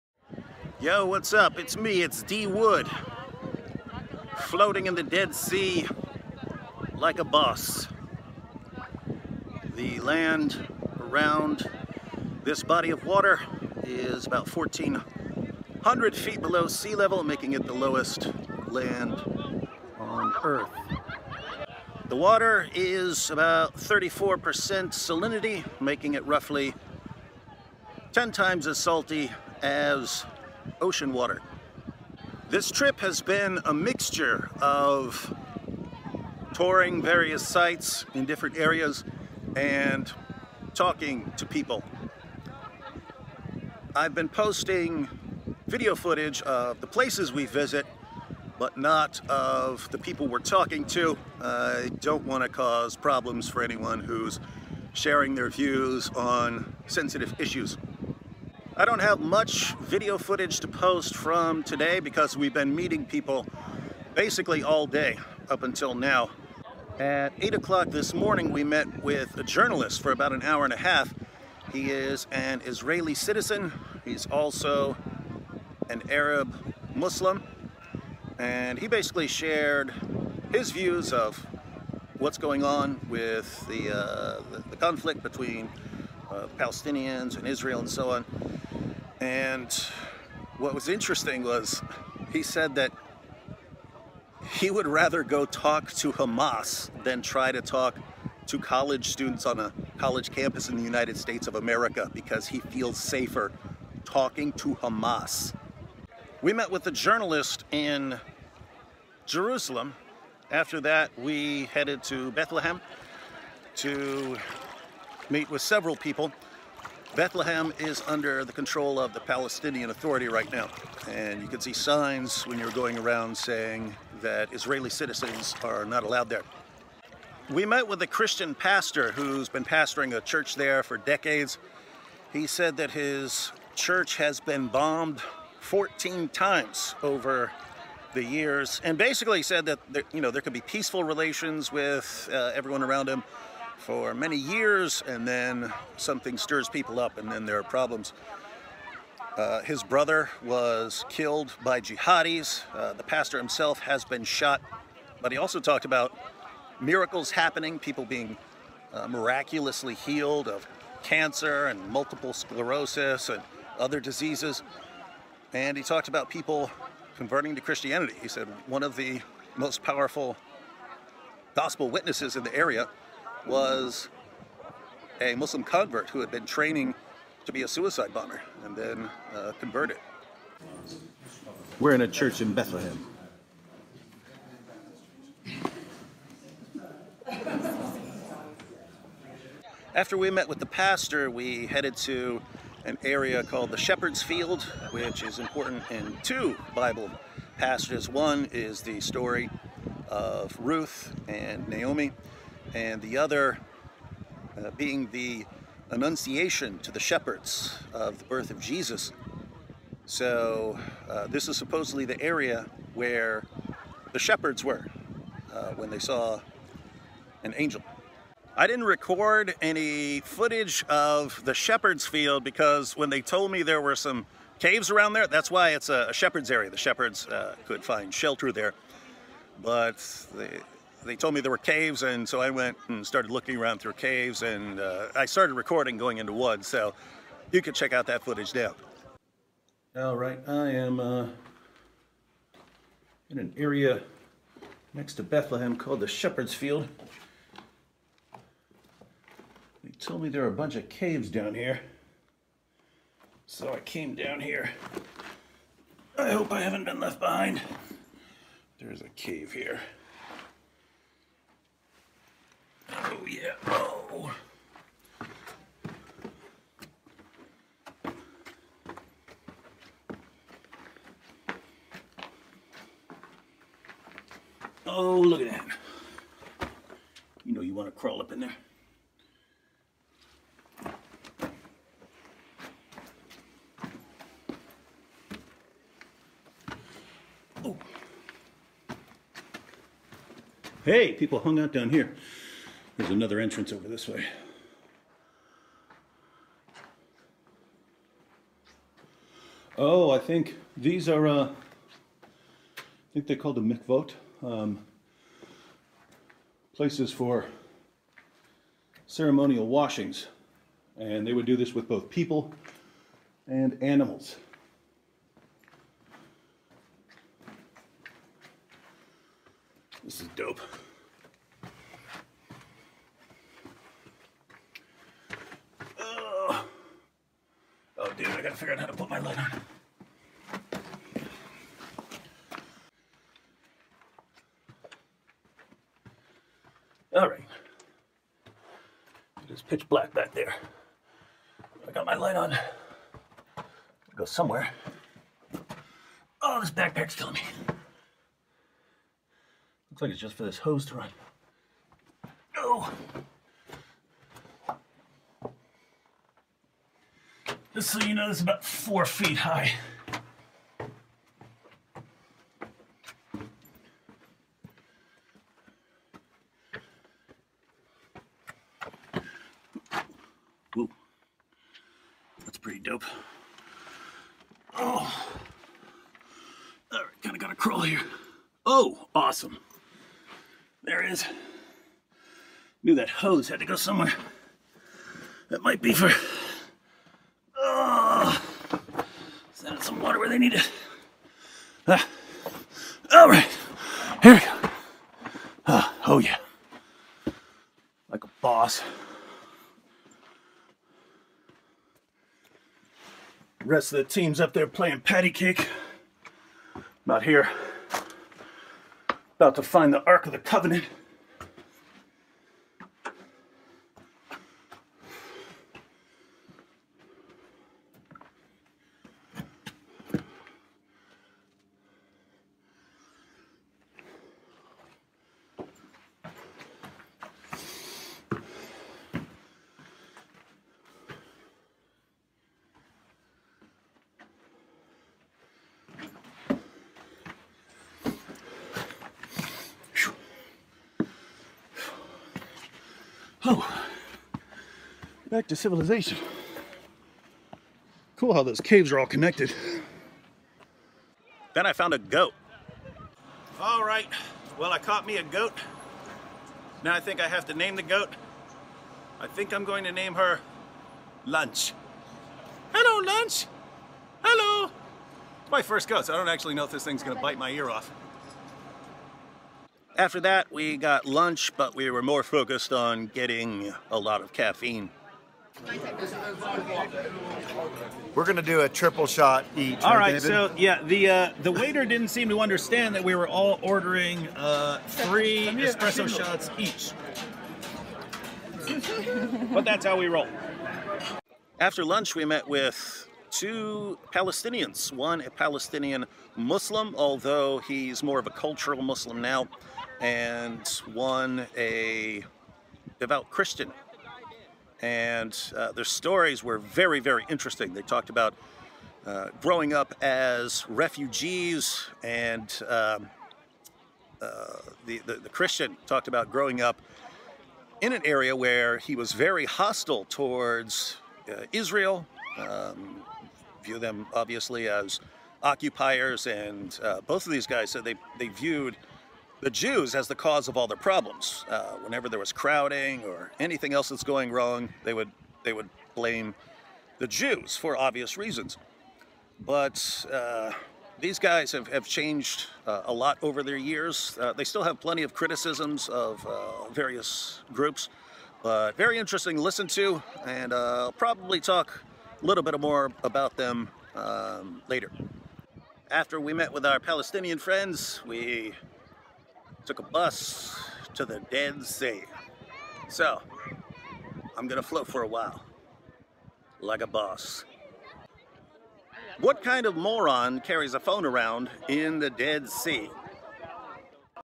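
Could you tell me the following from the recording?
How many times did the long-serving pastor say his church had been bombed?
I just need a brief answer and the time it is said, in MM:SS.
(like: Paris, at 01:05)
14, at 02:15.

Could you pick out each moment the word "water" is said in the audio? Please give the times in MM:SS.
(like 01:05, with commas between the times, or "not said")
00:13, 00:22, 00:31, 06:30.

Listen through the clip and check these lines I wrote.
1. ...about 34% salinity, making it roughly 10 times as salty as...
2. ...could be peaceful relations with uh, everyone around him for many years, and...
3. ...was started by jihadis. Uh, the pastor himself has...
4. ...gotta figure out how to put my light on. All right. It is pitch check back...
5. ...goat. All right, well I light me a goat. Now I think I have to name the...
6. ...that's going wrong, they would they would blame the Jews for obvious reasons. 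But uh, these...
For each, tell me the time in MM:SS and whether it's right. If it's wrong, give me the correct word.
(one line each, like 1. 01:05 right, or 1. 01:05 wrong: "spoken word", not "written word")
1. 00:23 right
2. 02:20 right
3. 02:30 wrong: "killed", not "started"
4. 05:28 wrong: "black", not "check"
5. 07:31 wrong: "caught", not "light"
6. 08:53 right.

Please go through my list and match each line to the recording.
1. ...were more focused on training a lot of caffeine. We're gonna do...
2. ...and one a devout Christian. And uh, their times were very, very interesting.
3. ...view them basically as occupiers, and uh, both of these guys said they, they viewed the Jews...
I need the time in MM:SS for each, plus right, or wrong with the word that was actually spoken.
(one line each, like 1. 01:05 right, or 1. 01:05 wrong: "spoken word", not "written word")
1. 07:51 wrong: "getting", not "training"
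2. 08:20 wrong: "stories", not "times"
3. 08:43 wrong: "obviously", not "basically".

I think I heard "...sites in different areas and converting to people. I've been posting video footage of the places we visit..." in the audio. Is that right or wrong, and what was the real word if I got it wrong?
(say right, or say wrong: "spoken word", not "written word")
wrong: "talking", not "converting".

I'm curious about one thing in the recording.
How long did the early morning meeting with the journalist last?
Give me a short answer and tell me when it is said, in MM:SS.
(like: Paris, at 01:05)
an hour and a half, at 01:10.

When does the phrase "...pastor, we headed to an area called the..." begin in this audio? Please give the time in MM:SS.
03:10.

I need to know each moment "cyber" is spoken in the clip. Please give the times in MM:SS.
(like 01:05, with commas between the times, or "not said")
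not said.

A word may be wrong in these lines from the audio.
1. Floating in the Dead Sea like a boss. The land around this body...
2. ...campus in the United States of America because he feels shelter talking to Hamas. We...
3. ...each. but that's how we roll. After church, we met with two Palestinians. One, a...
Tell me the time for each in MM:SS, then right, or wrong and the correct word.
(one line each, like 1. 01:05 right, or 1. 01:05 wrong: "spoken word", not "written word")
1. 00:04 right
2. 01:40 wrong: "safer", not "shelter"
3. 08:06 wrong: "lunch", not "church".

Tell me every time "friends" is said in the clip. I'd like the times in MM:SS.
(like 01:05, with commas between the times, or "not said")
09:17.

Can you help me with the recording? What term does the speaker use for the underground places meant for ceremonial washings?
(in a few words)
mikvot.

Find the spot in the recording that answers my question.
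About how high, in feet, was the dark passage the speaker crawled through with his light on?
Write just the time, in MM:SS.
05:58.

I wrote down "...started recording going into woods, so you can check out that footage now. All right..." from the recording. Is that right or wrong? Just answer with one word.
right.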